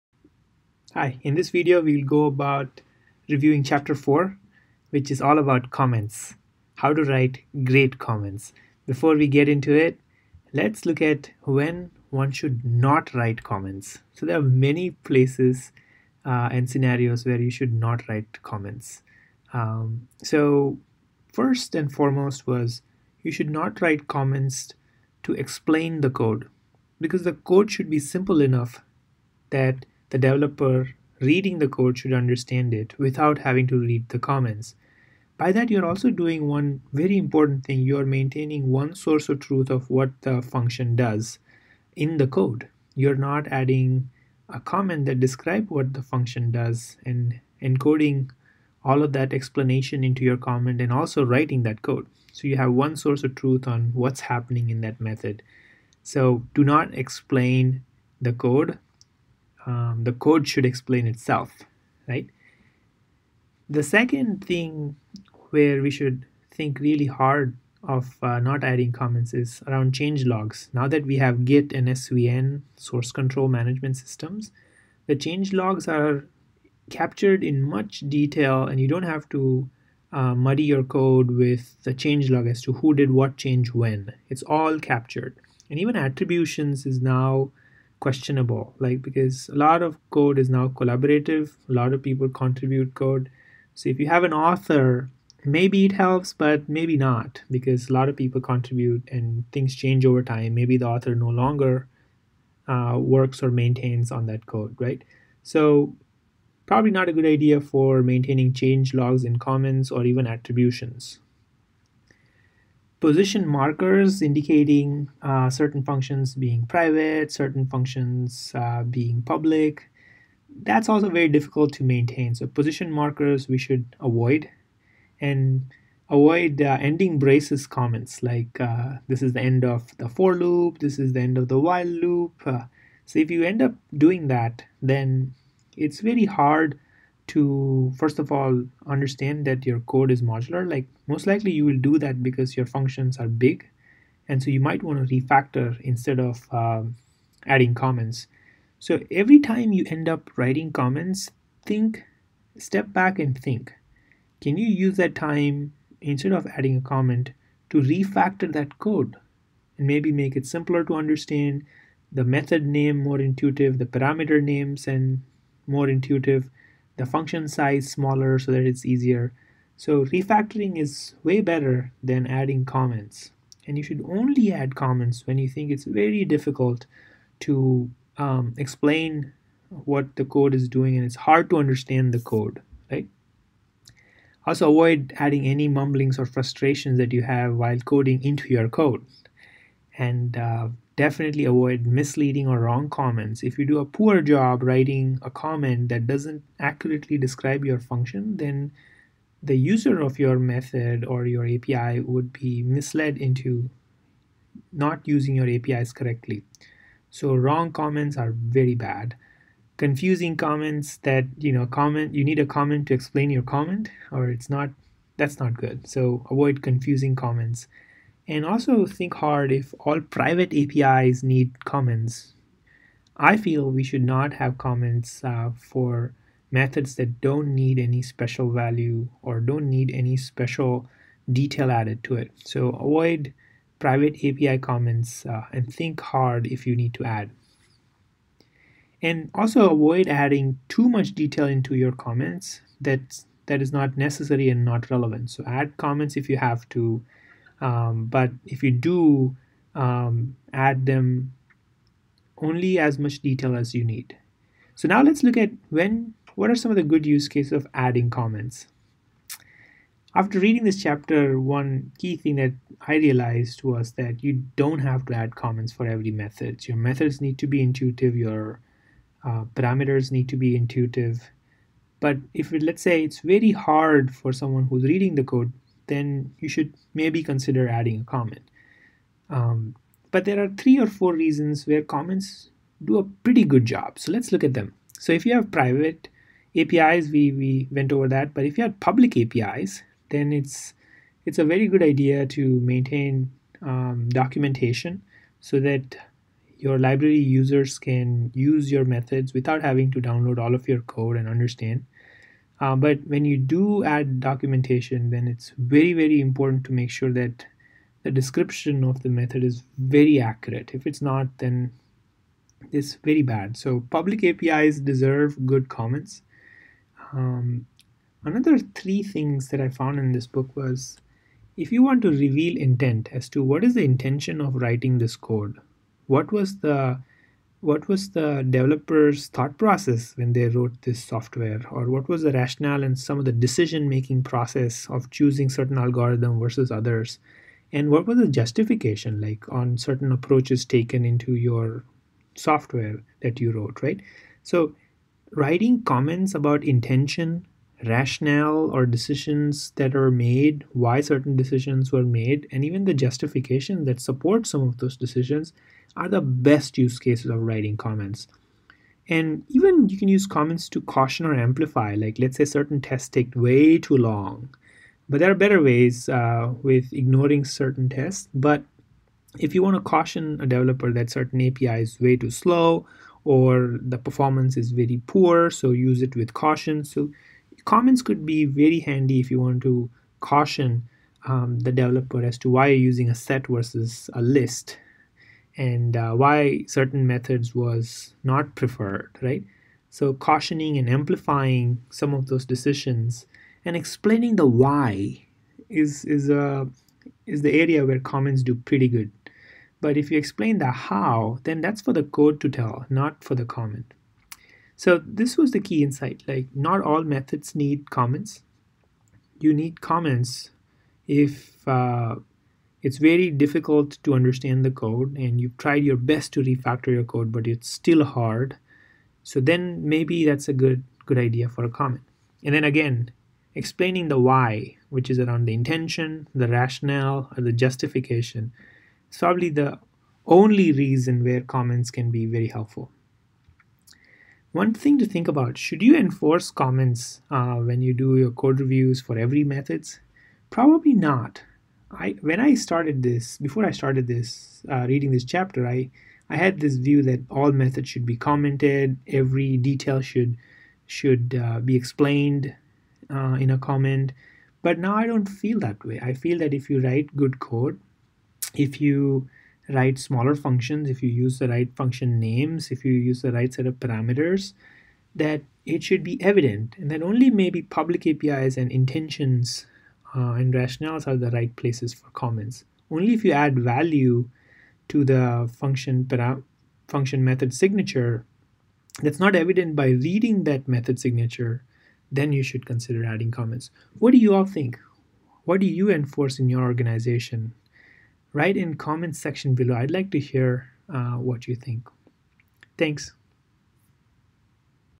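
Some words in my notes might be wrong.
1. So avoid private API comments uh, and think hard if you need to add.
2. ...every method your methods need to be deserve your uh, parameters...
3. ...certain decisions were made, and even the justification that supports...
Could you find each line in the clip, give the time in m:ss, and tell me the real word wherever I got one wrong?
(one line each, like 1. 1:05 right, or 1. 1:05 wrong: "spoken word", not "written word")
1. 3:52 right
2. 4:25 wrong: "intuitive", not "deserve"
3. 5:51 right.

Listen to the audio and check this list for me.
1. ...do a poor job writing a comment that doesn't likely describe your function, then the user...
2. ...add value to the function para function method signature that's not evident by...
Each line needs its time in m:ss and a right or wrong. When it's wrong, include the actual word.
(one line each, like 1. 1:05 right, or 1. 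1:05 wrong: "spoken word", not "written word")
1. 3:13 wrong: "accurately", not "likely"
2. 7:53 right.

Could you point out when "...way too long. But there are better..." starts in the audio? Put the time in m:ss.
6:03.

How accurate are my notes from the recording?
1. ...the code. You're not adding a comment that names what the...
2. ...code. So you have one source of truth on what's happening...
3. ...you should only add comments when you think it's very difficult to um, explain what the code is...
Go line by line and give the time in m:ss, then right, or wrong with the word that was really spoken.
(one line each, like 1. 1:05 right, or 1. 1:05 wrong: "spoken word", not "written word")
1. 0:42 wrong: "describes", not "names"
2. 0:51 right
3. 2:53 right.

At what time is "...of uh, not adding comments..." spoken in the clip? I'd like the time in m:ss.
1:07.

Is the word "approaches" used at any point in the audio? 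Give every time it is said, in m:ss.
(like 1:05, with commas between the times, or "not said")
5:40.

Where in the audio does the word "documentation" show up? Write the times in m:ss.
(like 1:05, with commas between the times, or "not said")
4:54, 5:04.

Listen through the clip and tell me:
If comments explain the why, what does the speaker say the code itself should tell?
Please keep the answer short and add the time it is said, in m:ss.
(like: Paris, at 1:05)
The how, at 6:40.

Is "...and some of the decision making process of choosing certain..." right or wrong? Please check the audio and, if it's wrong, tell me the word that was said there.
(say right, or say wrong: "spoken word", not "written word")
right.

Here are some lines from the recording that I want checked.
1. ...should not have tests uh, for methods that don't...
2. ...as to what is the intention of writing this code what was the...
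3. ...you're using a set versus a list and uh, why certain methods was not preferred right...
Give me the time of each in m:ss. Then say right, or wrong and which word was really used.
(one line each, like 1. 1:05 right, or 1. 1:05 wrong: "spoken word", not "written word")
1. 3:43 wrong: "comments", not "tests"
2. 5:23 right
3. 6:22 right.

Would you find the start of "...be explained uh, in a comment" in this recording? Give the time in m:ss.
7:31.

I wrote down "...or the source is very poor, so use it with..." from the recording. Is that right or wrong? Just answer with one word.
wrong.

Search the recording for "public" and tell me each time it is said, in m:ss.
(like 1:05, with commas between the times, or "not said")
1:59, 4:48, 5:13, 7:47.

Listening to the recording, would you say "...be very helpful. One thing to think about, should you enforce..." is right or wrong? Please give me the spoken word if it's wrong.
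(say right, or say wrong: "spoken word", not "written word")
right.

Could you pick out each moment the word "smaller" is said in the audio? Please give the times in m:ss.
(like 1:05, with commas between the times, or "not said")
2:47, 7:39.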